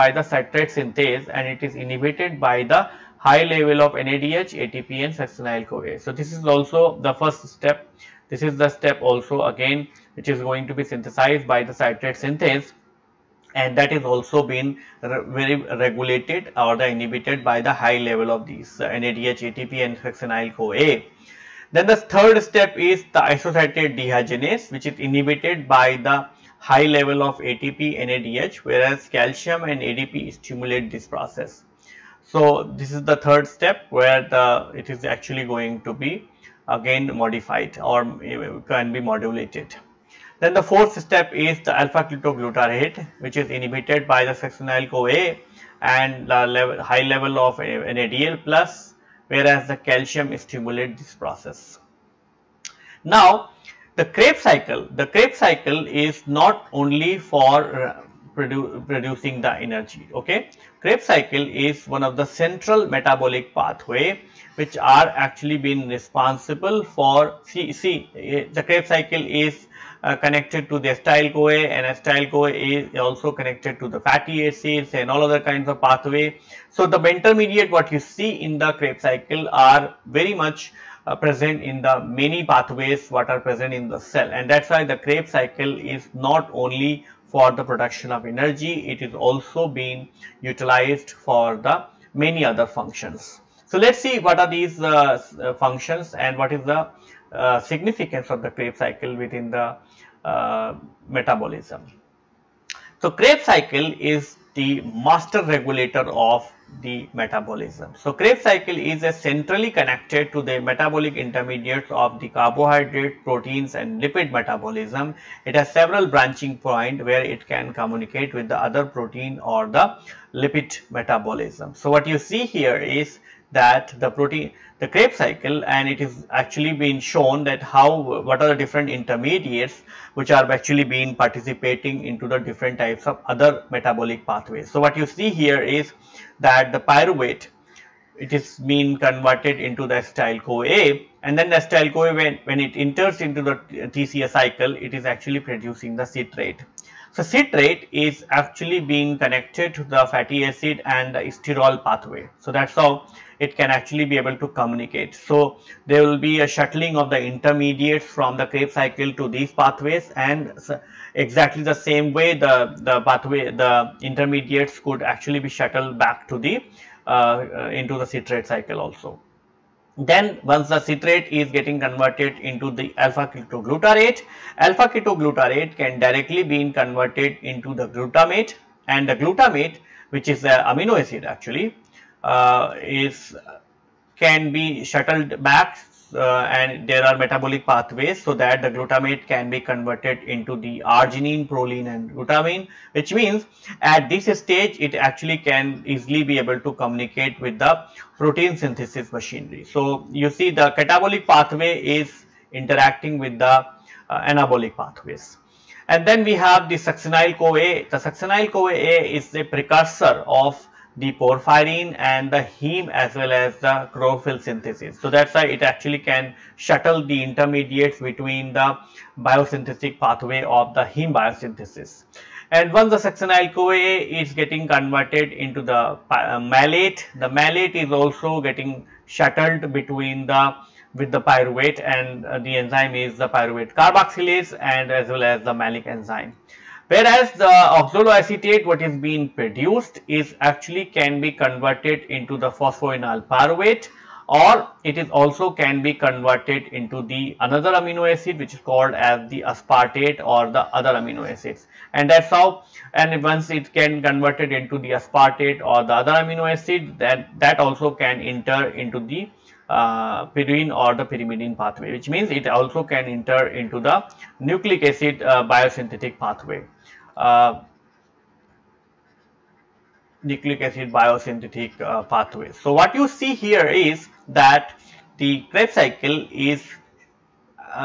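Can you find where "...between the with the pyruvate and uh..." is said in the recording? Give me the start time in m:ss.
3:49.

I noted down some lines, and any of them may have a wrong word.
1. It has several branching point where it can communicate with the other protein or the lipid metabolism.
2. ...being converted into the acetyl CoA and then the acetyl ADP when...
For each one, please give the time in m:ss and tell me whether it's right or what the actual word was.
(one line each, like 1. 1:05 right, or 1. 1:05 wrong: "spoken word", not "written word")
1. 1:55 right
2. 2:18 wrong: "CoA", not "ADP".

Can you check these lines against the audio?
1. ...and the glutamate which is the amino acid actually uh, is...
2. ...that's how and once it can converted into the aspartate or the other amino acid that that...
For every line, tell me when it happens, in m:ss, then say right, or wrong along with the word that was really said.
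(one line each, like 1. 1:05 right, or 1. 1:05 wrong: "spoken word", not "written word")
1. 2:58 right
2. 4:12 right.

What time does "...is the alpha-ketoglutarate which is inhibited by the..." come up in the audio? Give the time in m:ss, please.
0:41.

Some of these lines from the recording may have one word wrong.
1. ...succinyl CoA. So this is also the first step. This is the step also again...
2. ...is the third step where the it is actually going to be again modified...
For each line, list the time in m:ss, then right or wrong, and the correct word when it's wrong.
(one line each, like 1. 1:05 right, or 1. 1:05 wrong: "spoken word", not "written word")
1. 0:05 right
2. 0:32 right.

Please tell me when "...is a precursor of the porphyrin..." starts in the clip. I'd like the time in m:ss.
3:29.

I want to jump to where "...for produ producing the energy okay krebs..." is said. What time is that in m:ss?
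0:57.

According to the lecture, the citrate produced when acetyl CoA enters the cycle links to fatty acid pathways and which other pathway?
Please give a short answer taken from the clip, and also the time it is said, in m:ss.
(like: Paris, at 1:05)
Sterol pathway, at 2:31.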